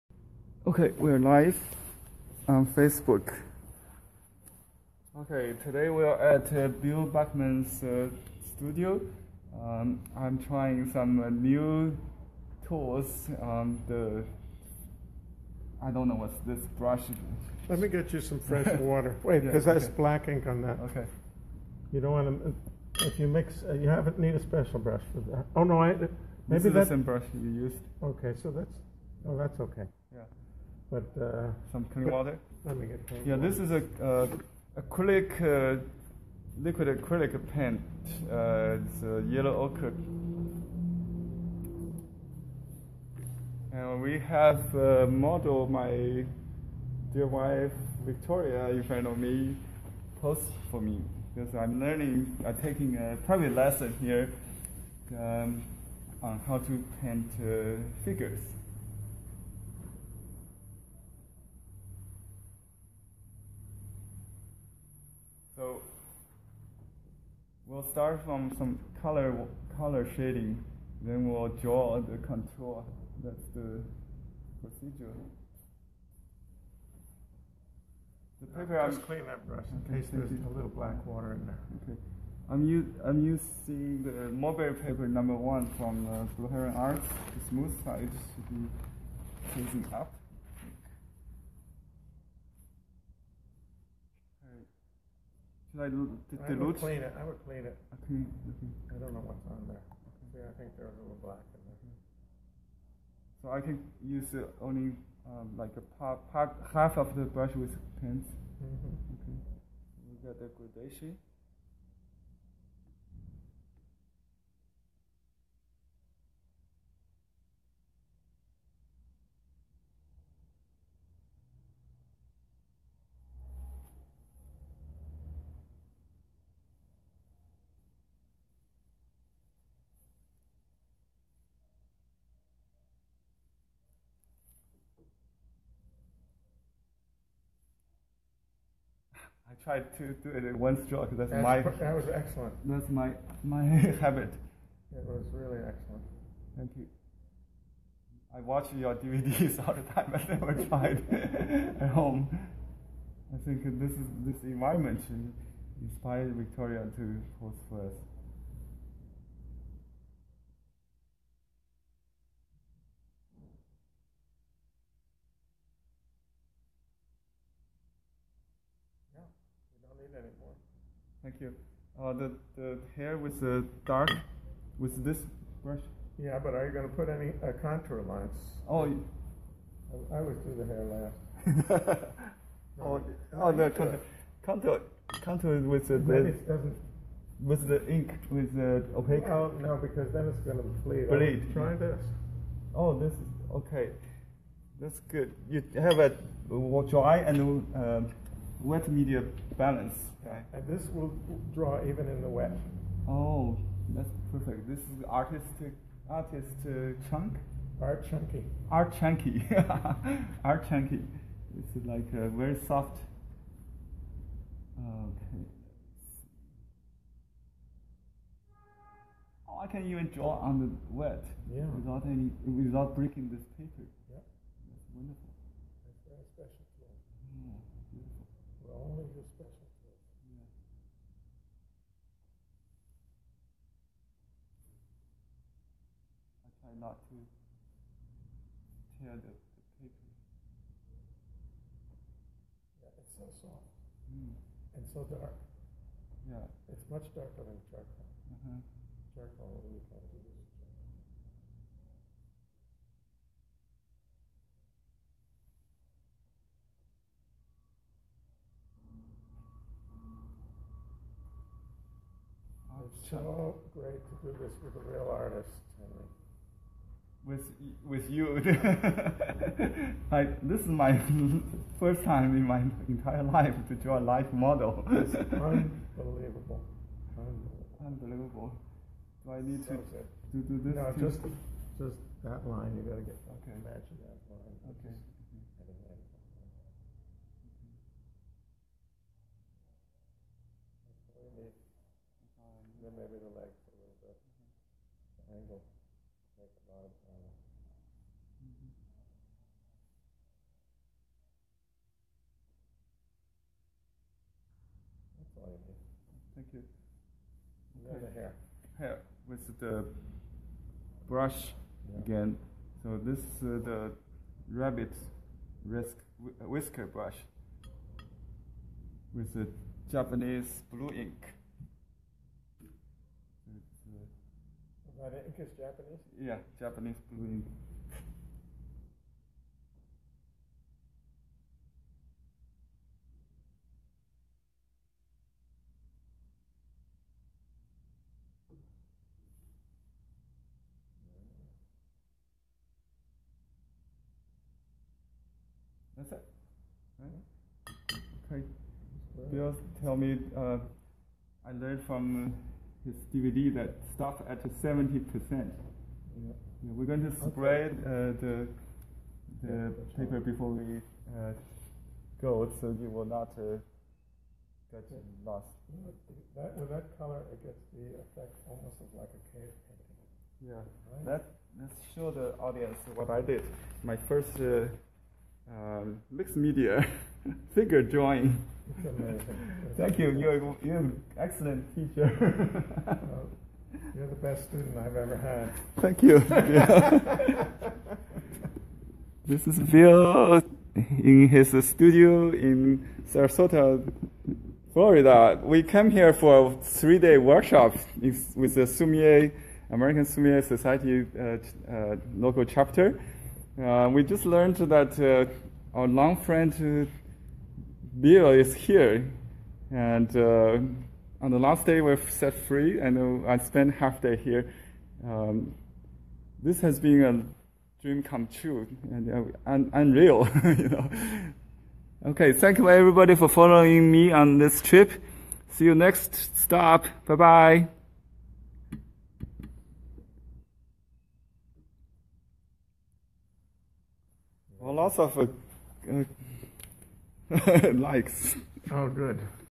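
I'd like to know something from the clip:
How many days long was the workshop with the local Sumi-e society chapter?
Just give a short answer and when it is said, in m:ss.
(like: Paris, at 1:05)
3 days, at 6:36.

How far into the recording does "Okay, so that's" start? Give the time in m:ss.
0:28.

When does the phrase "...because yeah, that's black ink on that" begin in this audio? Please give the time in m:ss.
0:19.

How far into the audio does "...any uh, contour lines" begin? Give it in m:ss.
2:57.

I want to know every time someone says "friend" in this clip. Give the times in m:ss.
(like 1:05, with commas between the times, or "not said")
6:46.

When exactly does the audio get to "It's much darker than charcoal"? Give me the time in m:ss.
4:06.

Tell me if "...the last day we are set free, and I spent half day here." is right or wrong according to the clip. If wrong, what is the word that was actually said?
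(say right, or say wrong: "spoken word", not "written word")
right.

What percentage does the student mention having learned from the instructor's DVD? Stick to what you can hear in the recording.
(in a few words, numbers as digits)
70%.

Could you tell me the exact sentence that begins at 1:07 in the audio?
We'll start from some color color shading, then we'll draw the contour.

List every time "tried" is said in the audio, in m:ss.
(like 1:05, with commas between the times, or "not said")
2:19, 2:30.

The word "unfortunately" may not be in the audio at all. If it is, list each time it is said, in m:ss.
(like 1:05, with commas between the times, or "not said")
not said.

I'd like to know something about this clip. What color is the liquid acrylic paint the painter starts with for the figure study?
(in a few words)
Yellow ochre.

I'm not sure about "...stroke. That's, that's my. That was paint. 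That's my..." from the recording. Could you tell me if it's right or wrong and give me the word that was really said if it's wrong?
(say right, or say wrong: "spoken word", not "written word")
wrong: "excellent", not "paint".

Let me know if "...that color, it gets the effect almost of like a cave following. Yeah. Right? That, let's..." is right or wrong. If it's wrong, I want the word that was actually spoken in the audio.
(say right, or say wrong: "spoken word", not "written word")
wrong: "painting", not "following".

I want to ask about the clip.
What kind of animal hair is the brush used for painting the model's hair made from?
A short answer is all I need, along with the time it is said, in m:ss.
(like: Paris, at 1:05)
Rabbit whisker, at 5:14.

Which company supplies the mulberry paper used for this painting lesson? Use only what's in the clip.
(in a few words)
Blue Heron Arts.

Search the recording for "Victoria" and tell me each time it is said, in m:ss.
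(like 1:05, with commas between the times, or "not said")
0:48, 2:36.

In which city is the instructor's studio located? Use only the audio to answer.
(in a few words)
Sarasota.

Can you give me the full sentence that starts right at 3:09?
Oh no, because then it's going to bleed.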